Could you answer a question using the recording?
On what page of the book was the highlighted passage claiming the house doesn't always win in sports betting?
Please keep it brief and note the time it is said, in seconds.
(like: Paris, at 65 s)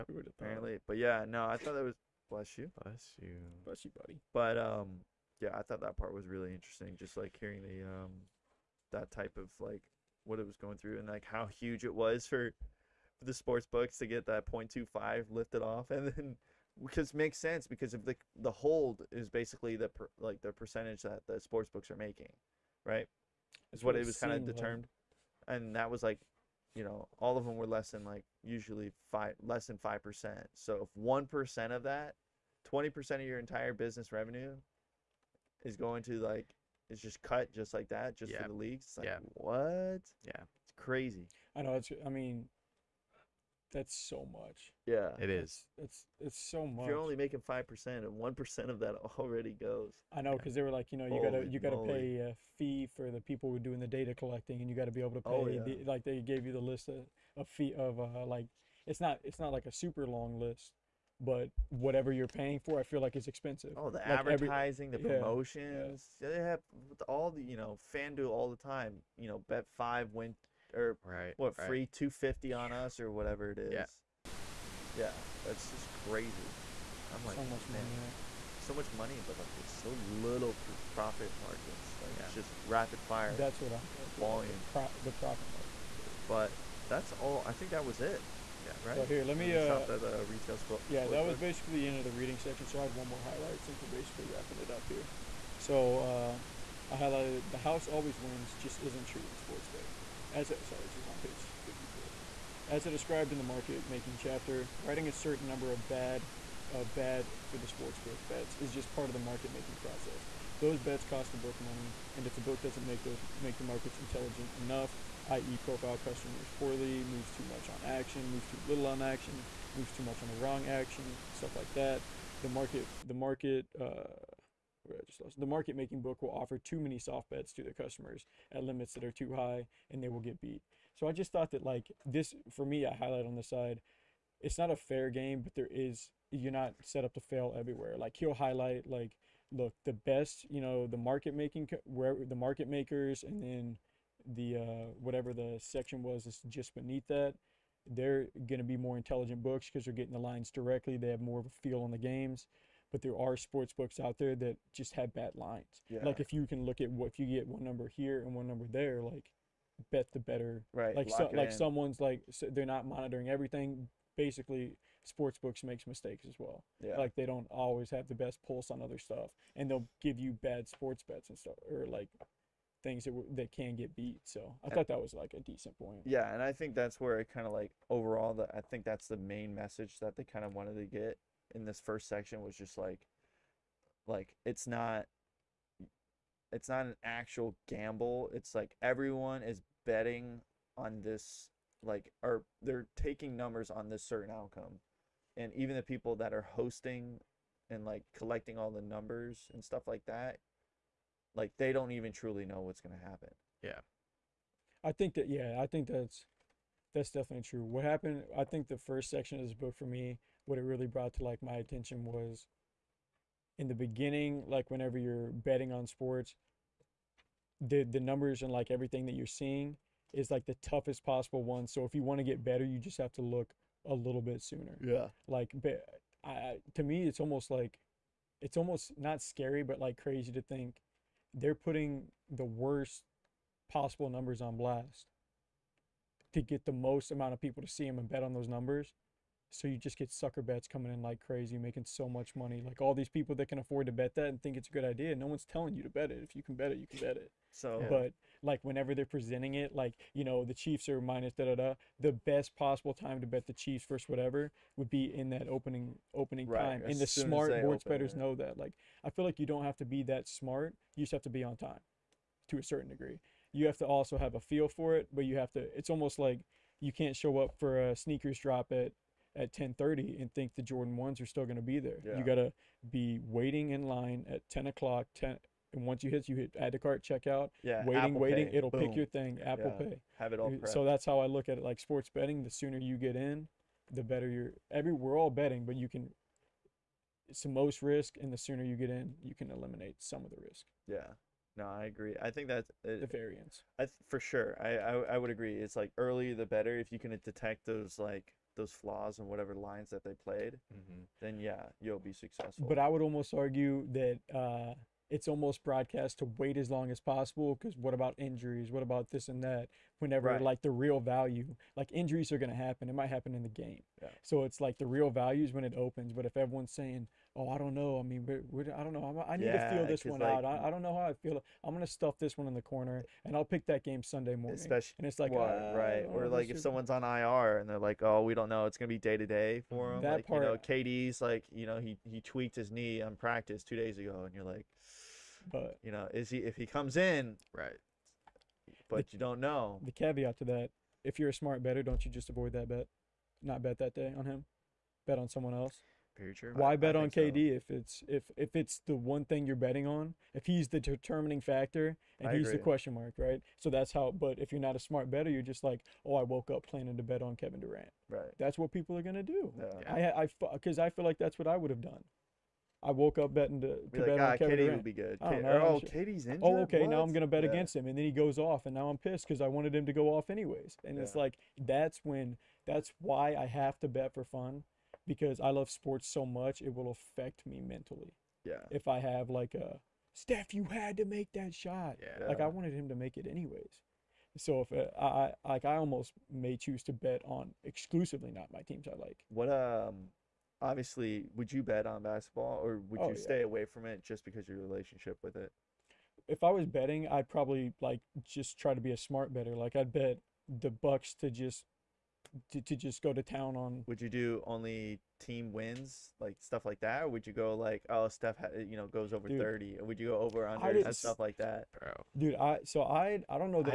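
54, at 101 s.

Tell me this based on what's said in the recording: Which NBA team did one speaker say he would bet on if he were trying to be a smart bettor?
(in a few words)
Bucks.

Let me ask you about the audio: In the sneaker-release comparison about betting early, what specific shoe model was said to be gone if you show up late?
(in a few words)
Jordan ones.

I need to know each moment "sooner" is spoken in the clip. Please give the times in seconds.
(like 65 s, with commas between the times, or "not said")
224 s, 282 s, 288 s.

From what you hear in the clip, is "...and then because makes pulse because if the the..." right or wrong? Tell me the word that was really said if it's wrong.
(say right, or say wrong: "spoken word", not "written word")
wrong: "sense", not "pulse".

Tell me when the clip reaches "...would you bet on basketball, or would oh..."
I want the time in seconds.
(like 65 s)
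391 s.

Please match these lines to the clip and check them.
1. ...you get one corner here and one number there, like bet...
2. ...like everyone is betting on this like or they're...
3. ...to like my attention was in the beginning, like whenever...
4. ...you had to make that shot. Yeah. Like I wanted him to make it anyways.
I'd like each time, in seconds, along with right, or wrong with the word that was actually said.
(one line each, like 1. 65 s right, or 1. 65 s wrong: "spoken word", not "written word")
1. 157 s wrong: "number", not "corner"
2. 188 s right
3. 211 s right
4. 380 s right.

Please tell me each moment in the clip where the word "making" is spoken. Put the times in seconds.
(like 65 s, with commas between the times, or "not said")
21 s, 47 s, 103 s, 109 s, 125 s, 141 s, 241 s.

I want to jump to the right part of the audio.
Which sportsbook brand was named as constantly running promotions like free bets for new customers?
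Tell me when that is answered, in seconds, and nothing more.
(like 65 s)
67 s.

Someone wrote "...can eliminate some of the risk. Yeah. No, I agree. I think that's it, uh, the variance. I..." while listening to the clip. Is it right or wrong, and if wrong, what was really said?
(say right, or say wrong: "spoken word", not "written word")
right.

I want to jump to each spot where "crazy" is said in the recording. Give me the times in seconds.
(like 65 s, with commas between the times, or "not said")
40 s, 75 s, 230 s, 241 s.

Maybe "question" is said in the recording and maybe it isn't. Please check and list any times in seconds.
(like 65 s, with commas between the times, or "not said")
352 s.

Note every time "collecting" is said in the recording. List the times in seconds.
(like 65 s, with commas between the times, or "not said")
54 s, 198 s.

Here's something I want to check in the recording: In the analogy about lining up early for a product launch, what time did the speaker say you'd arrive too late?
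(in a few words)
10:30.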